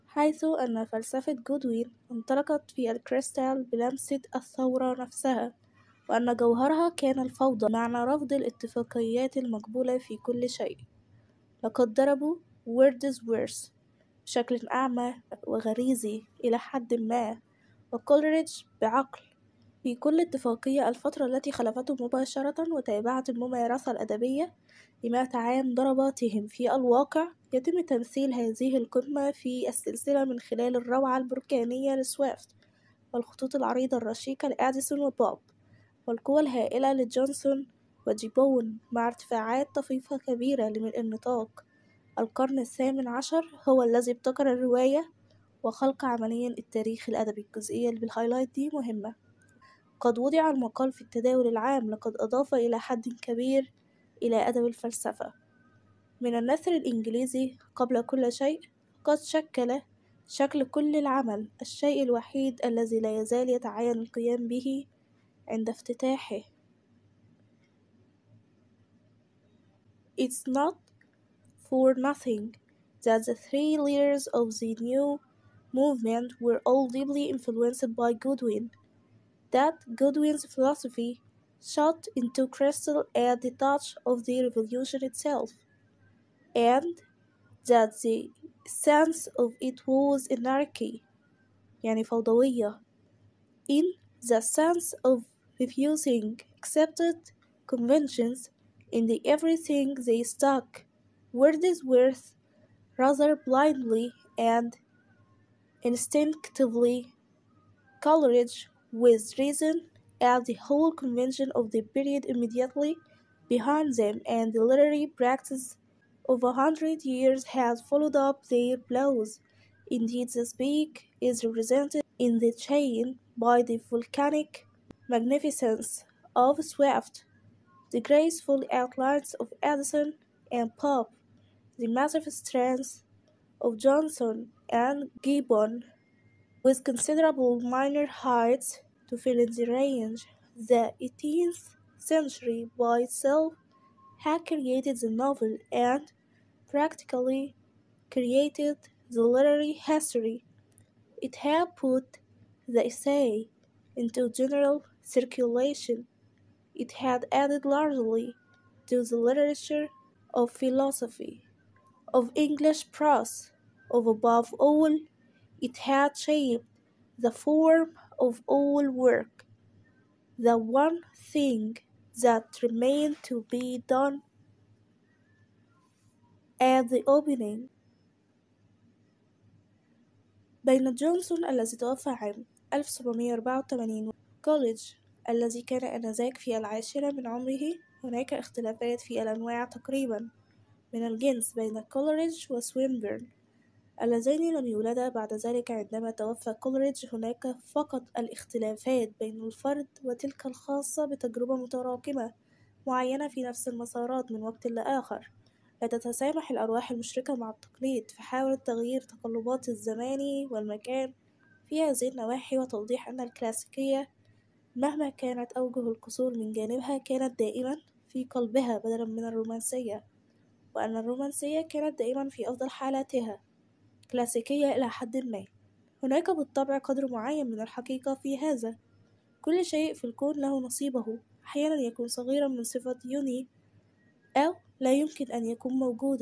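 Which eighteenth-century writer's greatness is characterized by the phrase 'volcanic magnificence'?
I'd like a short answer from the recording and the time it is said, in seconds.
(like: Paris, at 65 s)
Swift, at 126 s.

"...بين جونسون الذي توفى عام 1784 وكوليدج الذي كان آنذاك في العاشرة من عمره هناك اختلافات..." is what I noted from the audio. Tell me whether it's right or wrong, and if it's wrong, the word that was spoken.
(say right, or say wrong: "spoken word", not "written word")
right.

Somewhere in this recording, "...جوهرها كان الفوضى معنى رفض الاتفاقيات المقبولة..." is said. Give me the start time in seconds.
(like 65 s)
6 s.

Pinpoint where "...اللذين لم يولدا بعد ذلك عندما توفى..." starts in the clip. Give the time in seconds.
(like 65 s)
194 s.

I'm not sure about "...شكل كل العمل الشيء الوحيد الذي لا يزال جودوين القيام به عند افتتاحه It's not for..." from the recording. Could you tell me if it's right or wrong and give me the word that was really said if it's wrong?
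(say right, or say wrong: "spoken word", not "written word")
wrong: "يتعين", not "جودوين".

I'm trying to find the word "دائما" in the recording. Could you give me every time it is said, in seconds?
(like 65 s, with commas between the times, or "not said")
217 s, 221 s.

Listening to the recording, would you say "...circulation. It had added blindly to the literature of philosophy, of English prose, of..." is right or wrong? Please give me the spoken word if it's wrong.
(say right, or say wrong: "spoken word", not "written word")
wrong: "largely", not "blindly".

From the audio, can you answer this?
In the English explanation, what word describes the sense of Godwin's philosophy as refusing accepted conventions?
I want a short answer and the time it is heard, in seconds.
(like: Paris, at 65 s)
anarchy, at 90 s.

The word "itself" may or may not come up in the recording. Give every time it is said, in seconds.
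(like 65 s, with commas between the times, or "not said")
85 s, 143 s.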